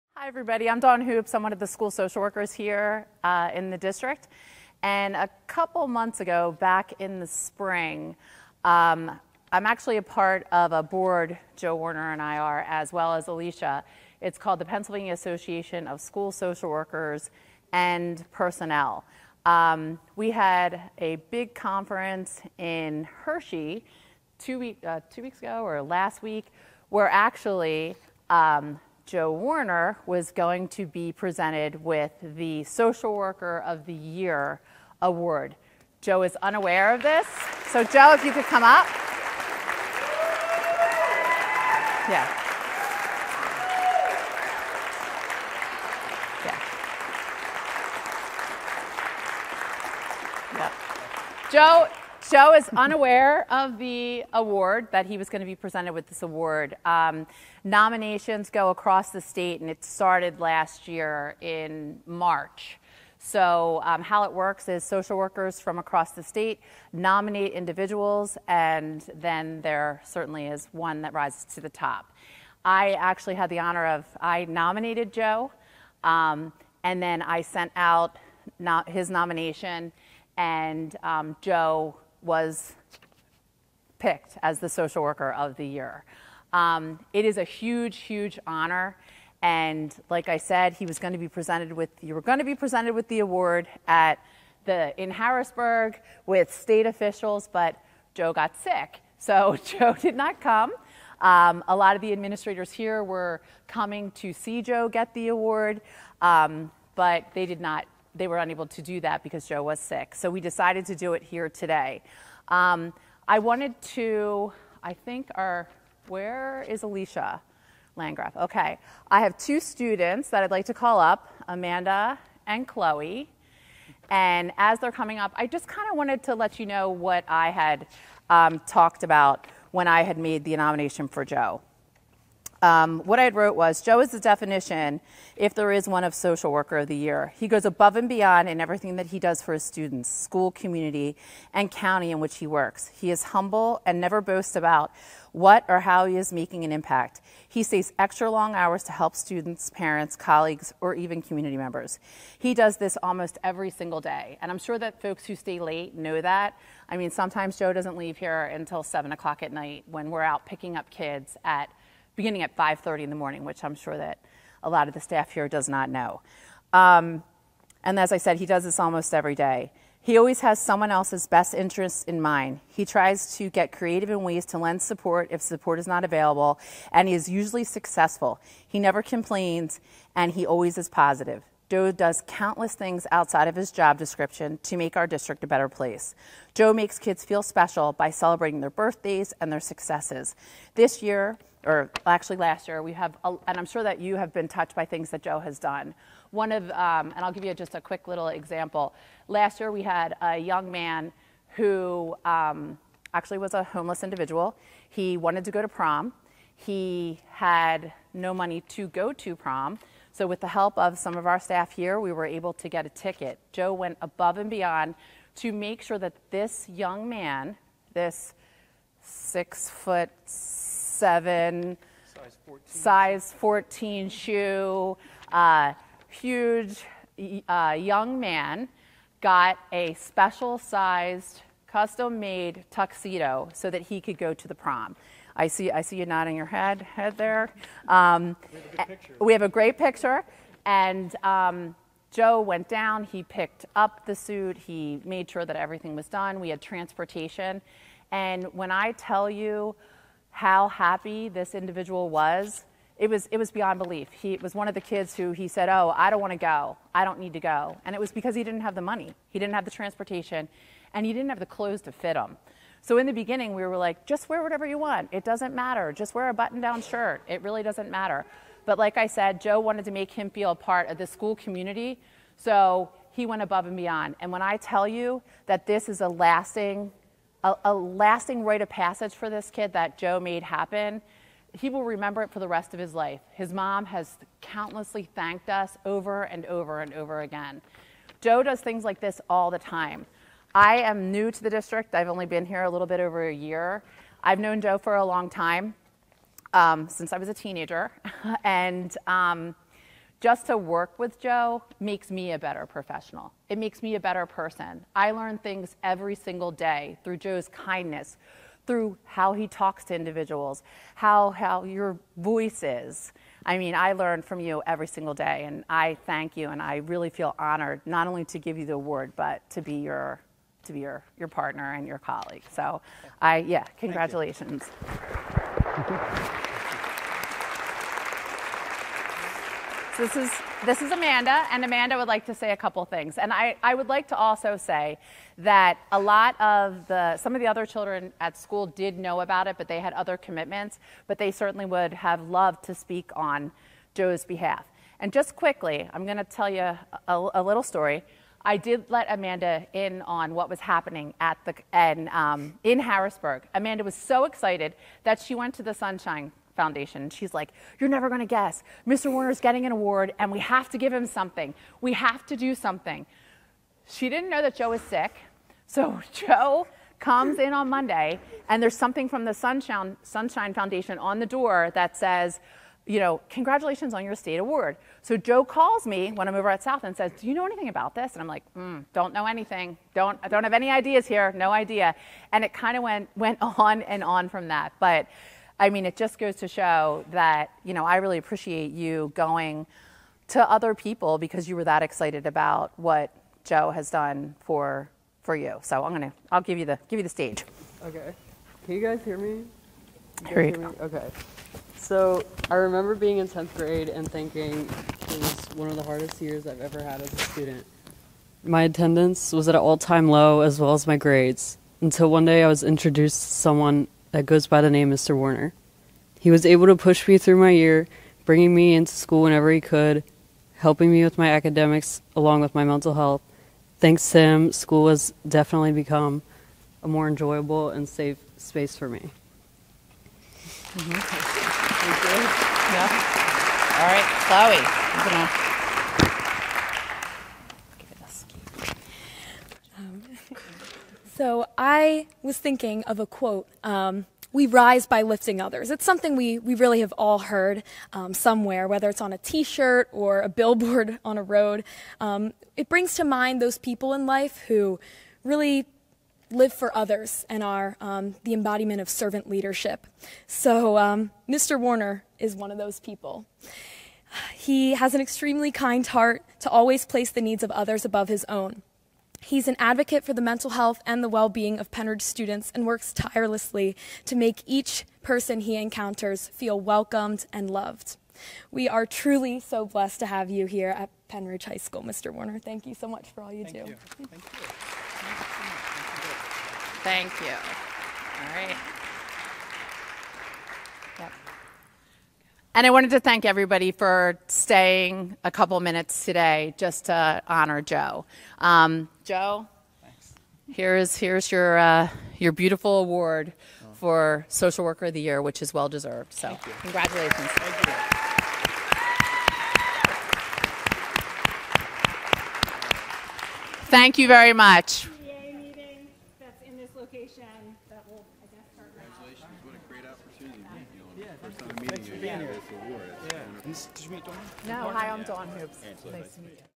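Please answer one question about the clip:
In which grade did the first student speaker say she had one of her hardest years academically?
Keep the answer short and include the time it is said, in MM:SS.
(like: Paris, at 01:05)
tenth grade, at 06:43.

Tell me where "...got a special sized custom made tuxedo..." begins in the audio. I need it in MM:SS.
03:49.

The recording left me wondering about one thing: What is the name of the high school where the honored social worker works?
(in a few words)
Pennridge High School.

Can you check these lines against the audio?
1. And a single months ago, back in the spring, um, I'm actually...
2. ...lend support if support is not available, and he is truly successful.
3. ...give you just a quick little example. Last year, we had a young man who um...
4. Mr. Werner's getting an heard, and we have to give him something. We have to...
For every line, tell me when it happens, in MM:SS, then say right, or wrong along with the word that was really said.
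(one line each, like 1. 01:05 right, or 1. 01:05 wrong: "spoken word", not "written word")
1. 00:04 wrong: "couple", not "single"
2. 02:54 wrong: "usually", not "truly"
3. 03:17 right
4. 05:58 wrong: "award", not "heard".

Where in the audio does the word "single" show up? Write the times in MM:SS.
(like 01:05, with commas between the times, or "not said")
02:33, 05:06, 05:14.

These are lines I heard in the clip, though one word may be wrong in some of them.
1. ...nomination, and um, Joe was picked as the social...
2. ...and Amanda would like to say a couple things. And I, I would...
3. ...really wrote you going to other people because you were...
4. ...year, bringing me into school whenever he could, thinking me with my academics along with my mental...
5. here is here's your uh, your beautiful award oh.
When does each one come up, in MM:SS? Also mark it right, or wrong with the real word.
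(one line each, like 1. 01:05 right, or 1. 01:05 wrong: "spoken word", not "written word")
1. 01:19 right
2. 05:31 right
3. 06:27 wrong: "appreciate", not "wrote"
4. 06:57 wrong: "helping", not "thinking"
5. 08:20 right.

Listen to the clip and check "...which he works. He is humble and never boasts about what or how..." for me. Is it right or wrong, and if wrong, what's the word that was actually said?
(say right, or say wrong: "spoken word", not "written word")
right.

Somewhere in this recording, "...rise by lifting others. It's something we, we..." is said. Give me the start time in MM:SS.
07:24.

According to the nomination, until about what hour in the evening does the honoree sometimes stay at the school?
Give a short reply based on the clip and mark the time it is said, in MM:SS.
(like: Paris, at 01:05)
7 o'clock, at 02:38.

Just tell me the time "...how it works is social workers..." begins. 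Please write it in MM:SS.
01:04.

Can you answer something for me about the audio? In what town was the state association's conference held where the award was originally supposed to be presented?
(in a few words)
Hershey.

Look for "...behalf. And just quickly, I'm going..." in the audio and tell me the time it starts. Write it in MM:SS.
05:44.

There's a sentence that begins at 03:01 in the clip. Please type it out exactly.
Joe does countless things outside of his job description to make our district a better place.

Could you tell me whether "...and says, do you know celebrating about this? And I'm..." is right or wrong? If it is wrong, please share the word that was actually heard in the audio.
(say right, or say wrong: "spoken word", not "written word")
wrong: "anything", not "celebrating".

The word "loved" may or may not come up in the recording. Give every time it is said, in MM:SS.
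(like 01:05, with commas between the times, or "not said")
05:42, 07:57.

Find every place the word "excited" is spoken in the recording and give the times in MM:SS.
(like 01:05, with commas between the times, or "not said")
05:54, 06:31.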